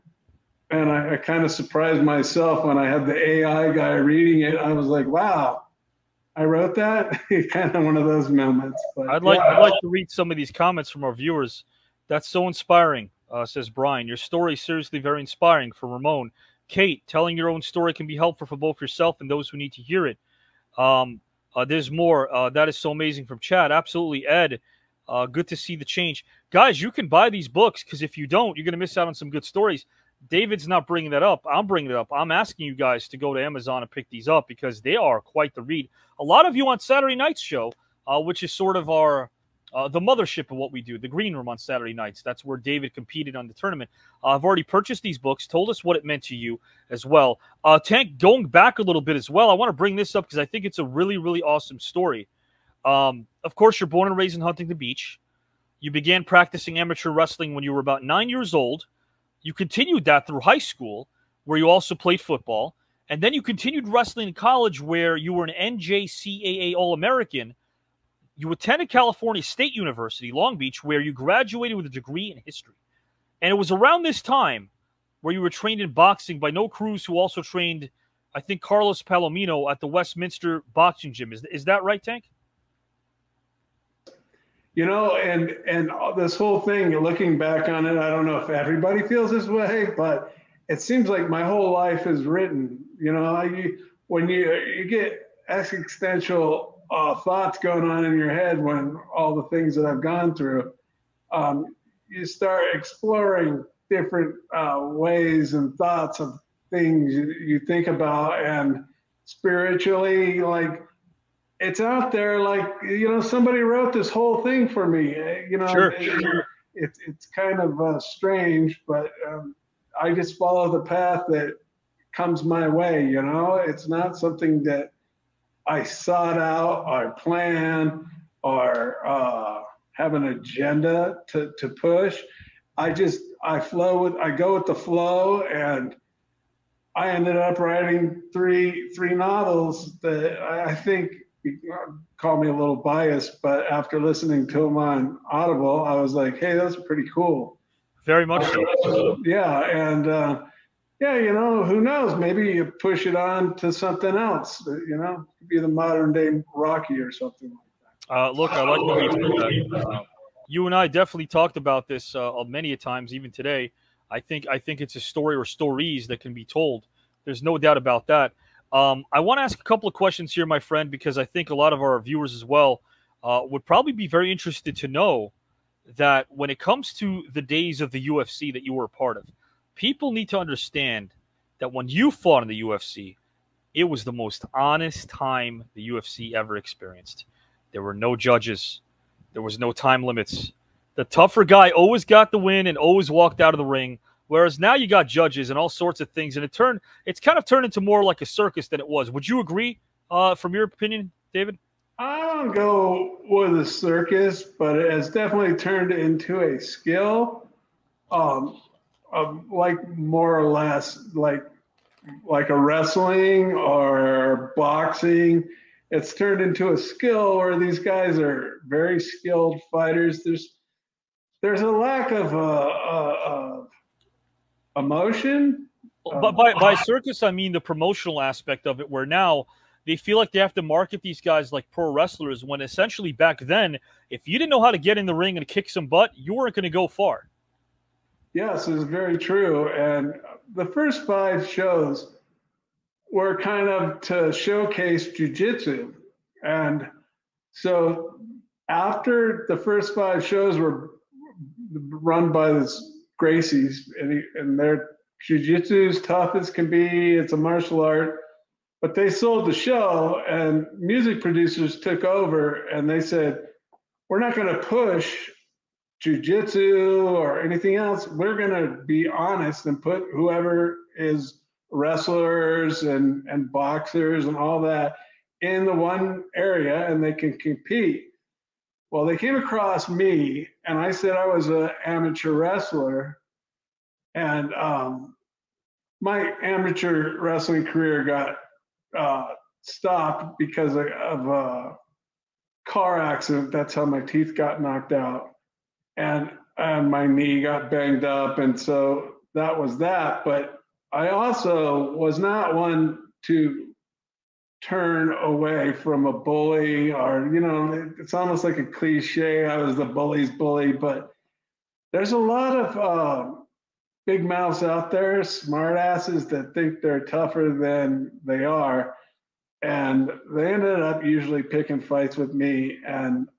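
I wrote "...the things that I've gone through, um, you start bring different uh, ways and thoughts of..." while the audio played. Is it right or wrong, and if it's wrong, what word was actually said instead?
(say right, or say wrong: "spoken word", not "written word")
wrong: "exploring", not "bring".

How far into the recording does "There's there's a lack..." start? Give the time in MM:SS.
03:40.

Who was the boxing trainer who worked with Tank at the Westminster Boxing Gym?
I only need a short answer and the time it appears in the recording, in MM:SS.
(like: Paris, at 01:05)
Noe Cruz, at 01:16.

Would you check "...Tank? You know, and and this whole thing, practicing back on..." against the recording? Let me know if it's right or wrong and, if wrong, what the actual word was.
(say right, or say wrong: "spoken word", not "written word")
wrong: "looking", not "practicing".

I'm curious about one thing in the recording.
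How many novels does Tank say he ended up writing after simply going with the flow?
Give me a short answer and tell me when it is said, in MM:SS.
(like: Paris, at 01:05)
3, at 02:18.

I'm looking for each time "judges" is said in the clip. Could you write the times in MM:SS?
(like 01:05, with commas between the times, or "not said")
03:08, 03:15.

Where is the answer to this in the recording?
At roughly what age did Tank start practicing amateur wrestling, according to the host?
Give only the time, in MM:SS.
00:58.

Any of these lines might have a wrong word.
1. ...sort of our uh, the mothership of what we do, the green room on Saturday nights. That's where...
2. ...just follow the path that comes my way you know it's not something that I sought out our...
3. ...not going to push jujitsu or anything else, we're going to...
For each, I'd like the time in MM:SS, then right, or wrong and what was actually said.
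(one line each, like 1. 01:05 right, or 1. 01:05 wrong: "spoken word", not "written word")
1. 00:38 right
2. 02:00 right
3. 04:24 right.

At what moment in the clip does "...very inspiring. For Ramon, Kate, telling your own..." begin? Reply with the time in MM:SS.
00:14.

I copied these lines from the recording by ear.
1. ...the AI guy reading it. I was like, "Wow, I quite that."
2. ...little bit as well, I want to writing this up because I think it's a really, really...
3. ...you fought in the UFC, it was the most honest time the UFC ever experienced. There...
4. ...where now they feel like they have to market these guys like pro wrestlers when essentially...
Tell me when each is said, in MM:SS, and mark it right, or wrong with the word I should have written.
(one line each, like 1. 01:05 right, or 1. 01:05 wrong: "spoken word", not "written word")
1. 00:03 wrong: "wrote", not "quite"
2. 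00:48 wrong: "bring", not "writing"
3. 03:01 right
4. 03:48 right.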